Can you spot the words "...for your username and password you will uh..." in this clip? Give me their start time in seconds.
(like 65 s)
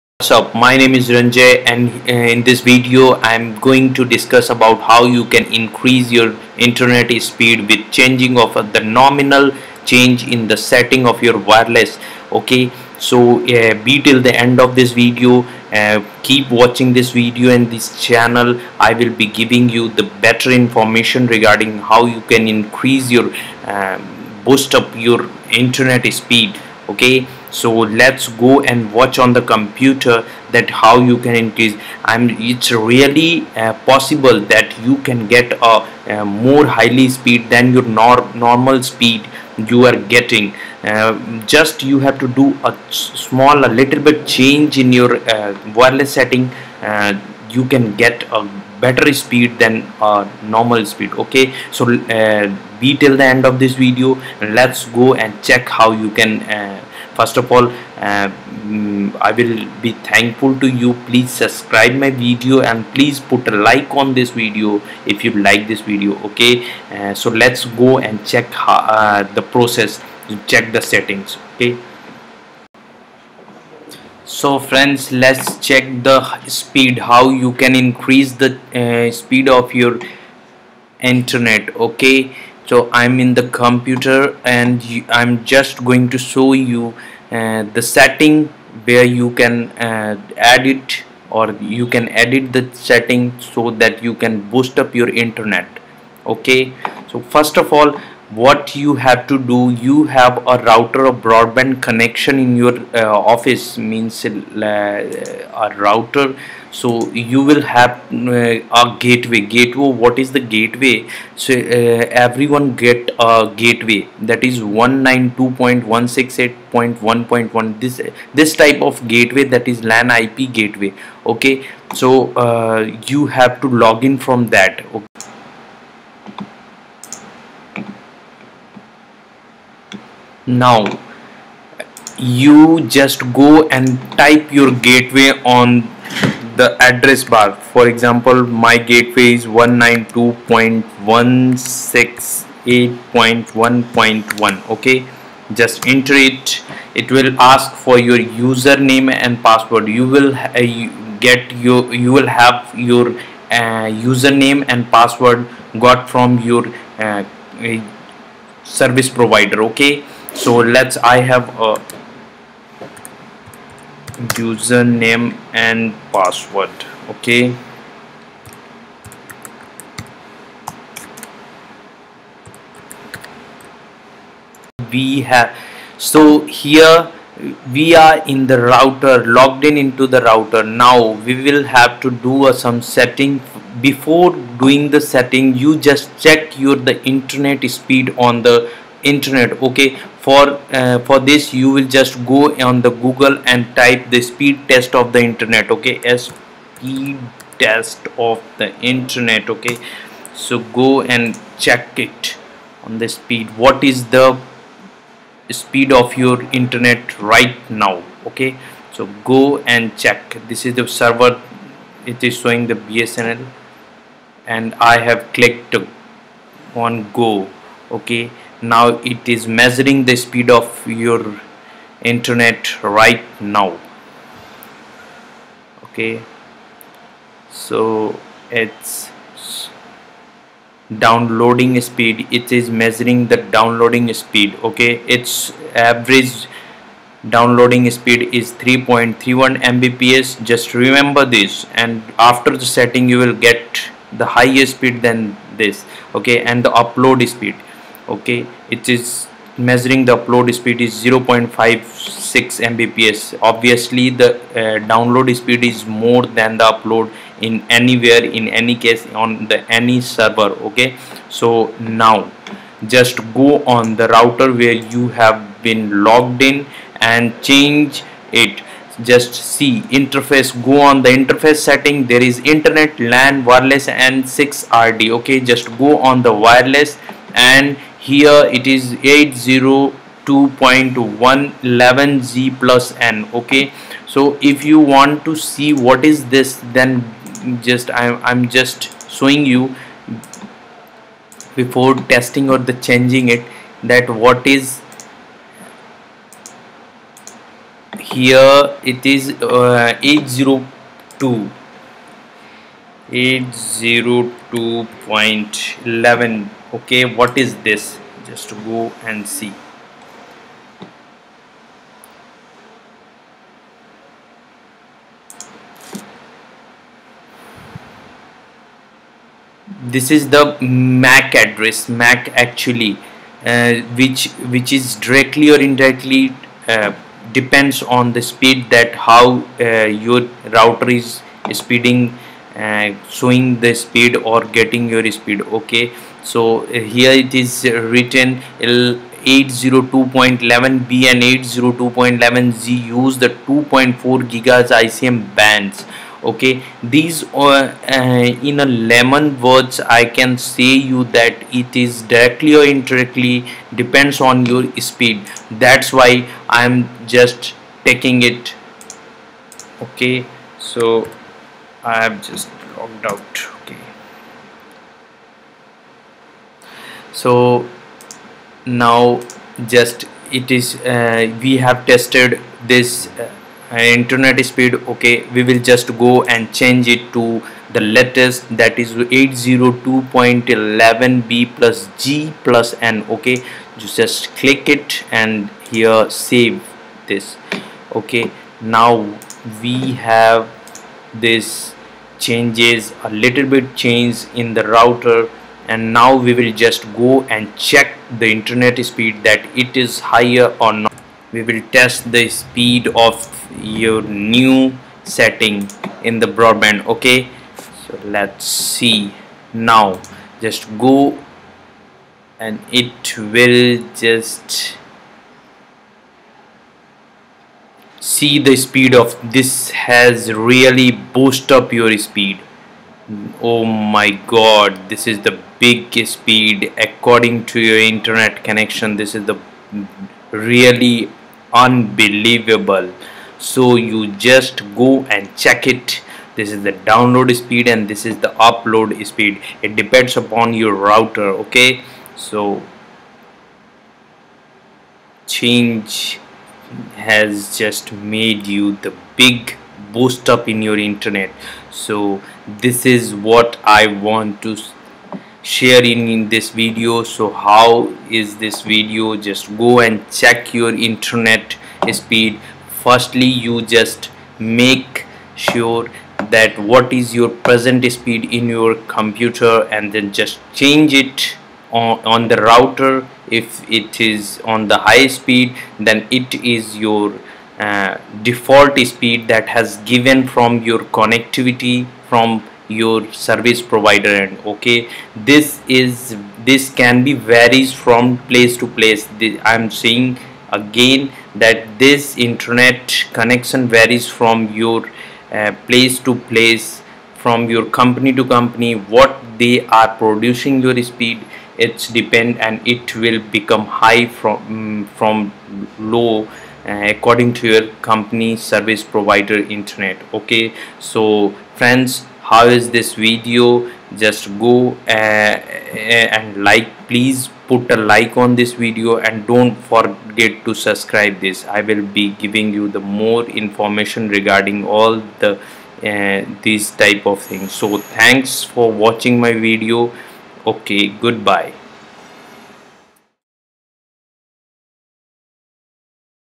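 147 s.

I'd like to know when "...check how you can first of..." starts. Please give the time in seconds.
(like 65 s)
55 s.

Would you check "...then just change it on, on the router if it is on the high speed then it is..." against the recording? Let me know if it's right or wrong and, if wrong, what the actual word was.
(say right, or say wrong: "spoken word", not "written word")
right.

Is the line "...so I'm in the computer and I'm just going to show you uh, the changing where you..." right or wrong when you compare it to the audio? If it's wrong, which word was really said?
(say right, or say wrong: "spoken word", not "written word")
wrong: "setting", not "changing".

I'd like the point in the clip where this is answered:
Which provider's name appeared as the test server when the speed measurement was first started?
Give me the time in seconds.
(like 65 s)
212 s.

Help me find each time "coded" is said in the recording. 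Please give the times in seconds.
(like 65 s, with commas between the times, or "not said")
not said.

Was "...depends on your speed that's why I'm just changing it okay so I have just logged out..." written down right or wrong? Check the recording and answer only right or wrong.
wrong.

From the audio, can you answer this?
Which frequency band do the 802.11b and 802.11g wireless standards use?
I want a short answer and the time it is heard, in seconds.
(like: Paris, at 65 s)
2.4 gigahertz, at 343 s.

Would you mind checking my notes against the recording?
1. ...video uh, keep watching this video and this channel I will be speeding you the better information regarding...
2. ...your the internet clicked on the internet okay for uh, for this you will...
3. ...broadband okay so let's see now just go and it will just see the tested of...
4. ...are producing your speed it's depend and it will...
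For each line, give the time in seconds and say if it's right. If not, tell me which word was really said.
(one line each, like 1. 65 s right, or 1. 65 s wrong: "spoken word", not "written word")
1. 14 s wrong: "giving", not "speeding"
2. 186 s wrong: "speed", not "clicked"
3. 406 s wrong: "speed", not "tested"
4. 499 s right.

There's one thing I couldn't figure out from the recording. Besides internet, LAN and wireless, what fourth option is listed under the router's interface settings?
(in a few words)
6RD.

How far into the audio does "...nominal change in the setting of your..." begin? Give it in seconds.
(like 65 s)
8 s.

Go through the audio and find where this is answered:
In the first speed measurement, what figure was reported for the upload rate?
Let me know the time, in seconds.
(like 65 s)
251 s.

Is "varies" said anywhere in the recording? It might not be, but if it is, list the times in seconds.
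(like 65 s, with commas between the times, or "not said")
487 s, 493 s.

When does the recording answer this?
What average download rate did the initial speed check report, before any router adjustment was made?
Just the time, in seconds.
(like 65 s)
238 s.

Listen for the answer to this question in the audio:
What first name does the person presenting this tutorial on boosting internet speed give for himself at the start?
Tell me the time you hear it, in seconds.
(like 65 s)
1 s.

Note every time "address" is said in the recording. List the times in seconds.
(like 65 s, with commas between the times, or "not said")
136 s, 321 s.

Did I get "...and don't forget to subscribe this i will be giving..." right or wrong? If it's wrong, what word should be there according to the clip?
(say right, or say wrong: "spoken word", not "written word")
right.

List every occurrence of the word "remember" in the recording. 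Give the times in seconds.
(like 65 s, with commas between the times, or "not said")
240 s.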